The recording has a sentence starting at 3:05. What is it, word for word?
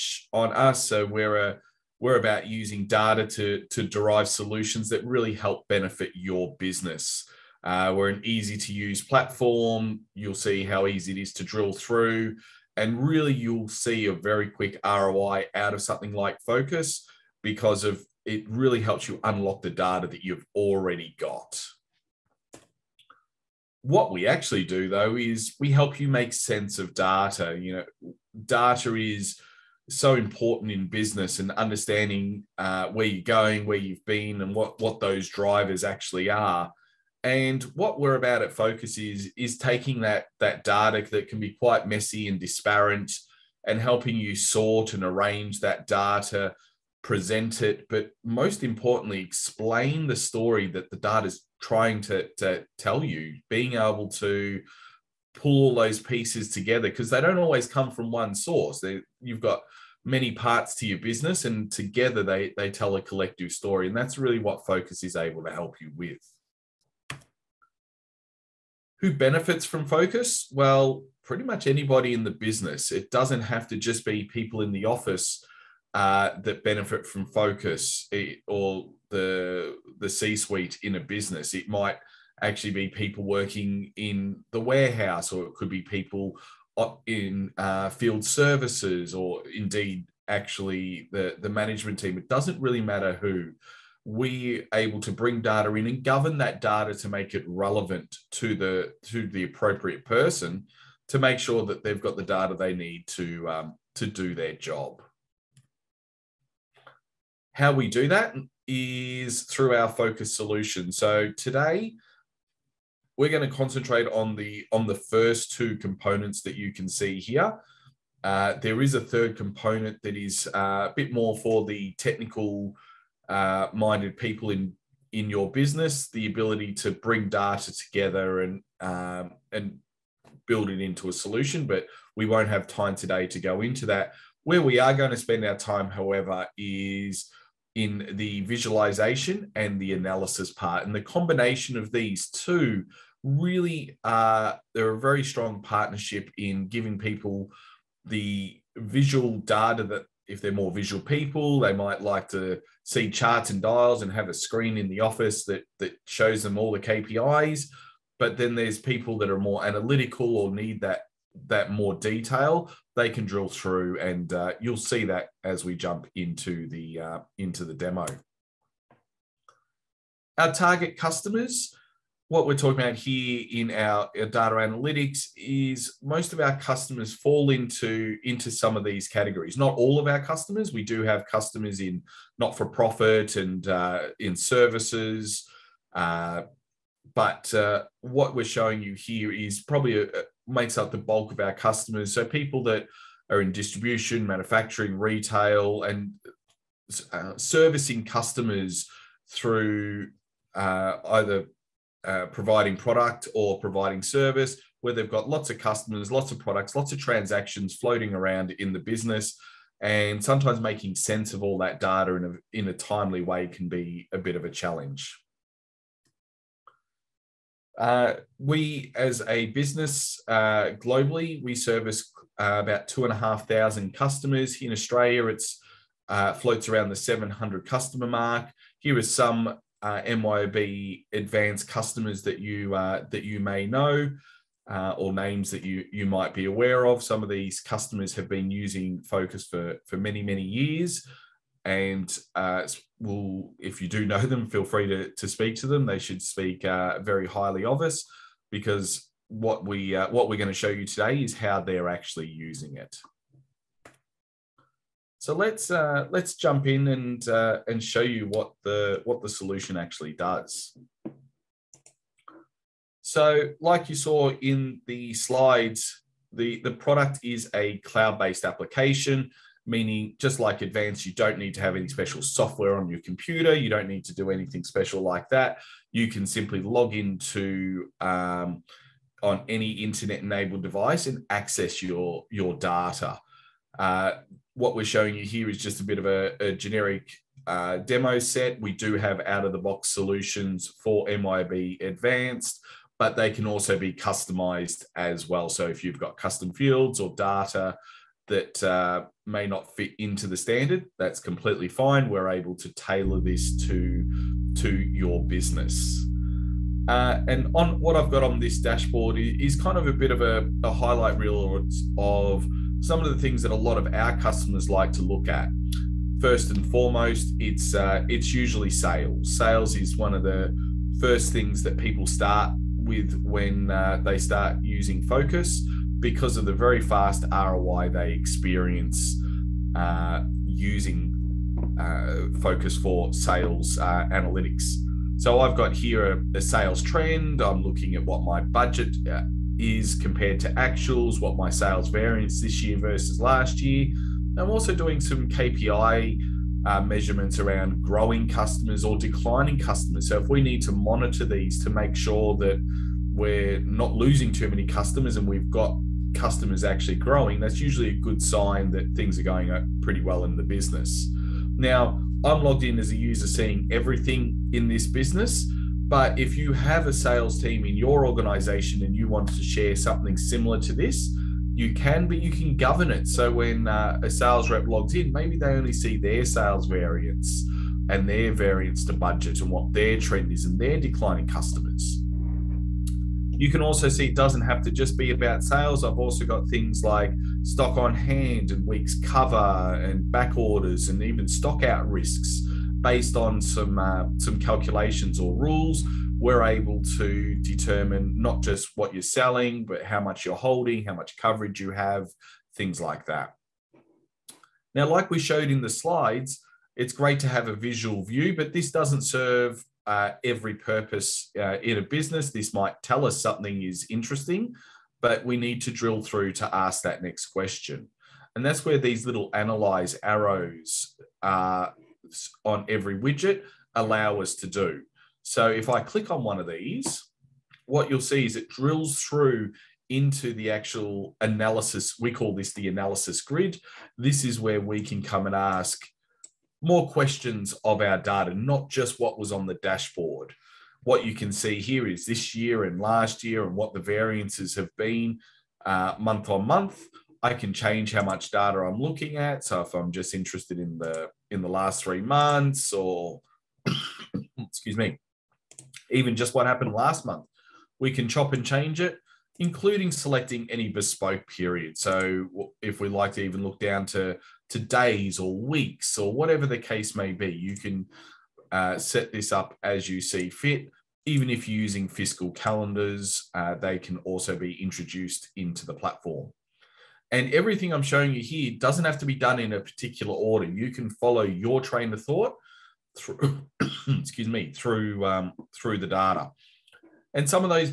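Uh, but uh, what we're showing you here is probably a, makes up the bulk of our customers.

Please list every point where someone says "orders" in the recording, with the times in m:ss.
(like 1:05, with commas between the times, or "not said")
6:30, 8:00.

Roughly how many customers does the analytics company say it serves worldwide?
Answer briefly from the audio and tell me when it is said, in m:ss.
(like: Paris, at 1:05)
2,500, at 3:42.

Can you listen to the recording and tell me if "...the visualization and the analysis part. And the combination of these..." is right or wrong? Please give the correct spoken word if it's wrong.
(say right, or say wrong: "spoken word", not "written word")
right.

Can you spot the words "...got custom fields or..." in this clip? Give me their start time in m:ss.
4:55.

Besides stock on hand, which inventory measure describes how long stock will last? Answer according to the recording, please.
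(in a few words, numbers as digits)
weeks cover.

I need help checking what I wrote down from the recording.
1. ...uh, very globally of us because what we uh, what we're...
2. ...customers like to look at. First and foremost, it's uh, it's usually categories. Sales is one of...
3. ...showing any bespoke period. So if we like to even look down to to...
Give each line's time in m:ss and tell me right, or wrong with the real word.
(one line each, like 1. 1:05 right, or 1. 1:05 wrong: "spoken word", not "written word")
1. 4:06 wrong: "highly", not "globally"
2. 5:14 wrong: "sales", not "categories"
3. 7:39 wrong: "selecting", not "showing".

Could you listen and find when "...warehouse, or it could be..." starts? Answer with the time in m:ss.
1:24.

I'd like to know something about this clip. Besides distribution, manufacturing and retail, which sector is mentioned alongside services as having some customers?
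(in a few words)
not for profit.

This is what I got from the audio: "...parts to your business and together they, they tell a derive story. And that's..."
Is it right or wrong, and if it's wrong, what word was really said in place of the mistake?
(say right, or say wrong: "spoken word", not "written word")
wrong: "collective", not "derive".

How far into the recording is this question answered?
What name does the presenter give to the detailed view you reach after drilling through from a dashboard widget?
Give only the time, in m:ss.
7:12.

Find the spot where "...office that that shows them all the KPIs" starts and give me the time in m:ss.
2:34.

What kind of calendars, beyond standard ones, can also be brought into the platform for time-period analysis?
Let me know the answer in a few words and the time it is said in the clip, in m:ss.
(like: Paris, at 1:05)
fiscal calendars, at 7:51.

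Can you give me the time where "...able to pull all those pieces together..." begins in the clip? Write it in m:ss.
0:53.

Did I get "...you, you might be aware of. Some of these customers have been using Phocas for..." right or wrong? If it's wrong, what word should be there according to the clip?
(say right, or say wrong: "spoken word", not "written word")
right.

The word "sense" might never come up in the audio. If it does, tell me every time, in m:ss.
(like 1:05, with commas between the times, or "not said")
0:26, 3:30.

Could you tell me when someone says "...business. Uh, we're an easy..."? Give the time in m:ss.
0:06.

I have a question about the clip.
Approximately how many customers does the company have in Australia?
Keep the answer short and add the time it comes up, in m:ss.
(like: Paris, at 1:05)
700, at 3:46.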